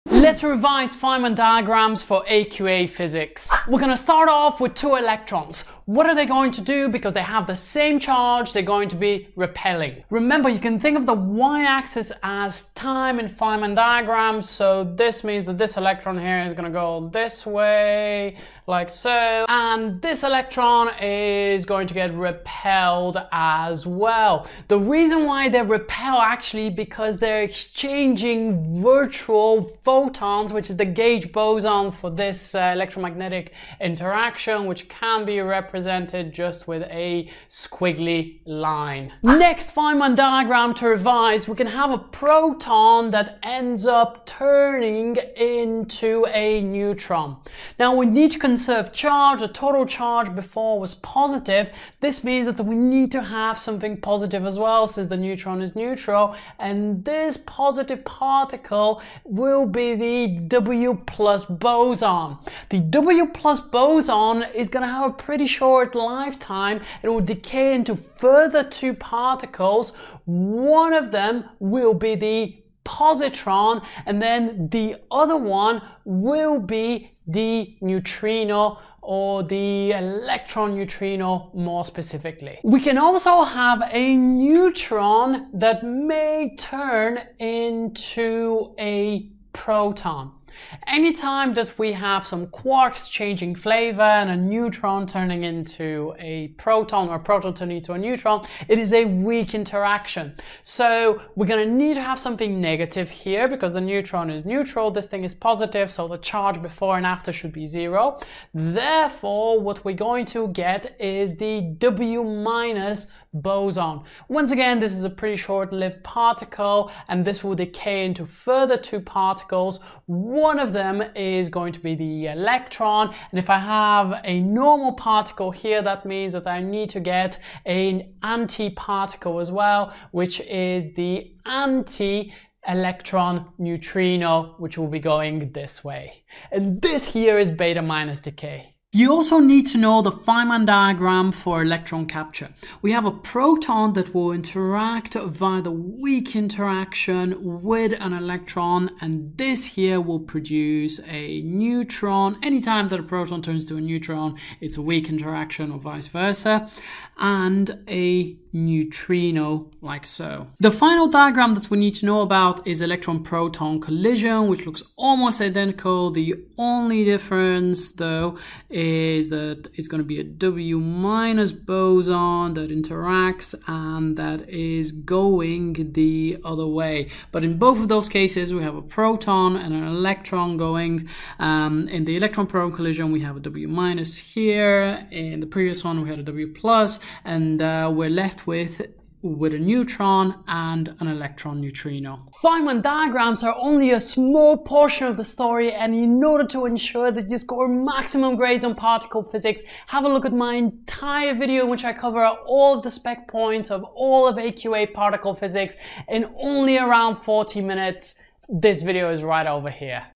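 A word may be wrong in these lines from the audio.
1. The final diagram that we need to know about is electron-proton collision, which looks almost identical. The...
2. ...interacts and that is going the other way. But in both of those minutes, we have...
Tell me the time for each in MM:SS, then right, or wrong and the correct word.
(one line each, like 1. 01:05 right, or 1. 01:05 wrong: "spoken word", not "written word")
1. 02:40 right
2. 02:52 wrong: "cases", not "minutes".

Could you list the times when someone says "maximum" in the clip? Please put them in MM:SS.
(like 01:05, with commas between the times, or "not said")
03:17.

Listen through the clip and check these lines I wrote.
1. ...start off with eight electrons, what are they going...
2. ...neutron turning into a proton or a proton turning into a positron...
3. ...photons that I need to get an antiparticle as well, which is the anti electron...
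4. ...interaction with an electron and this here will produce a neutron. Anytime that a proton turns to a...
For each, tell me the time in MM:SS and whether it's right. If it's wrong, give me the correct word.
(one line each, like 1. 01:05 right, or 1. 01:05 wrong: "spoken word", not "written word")
1. 00:03 wrong: "two", not "eight"
2. 01:34 wrong: "neutron", not "positron"
3. 02:06 wrong: "means", not "photons"
4. 02:26 right.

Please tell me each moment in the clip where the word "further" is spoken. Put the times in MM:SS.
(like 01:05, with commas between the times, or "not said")
01:07, 01:58.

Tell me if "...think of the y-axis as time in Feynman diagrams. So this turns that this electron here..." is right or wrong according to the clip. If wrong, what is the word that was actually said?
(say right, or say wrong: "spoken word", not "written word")
wrong: "means", not "turns".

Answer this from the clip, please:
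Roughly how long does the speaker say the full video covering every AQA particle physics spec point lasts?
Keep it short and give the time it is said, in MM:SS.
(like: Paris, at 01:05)
Around 40 minutes, at 03:26.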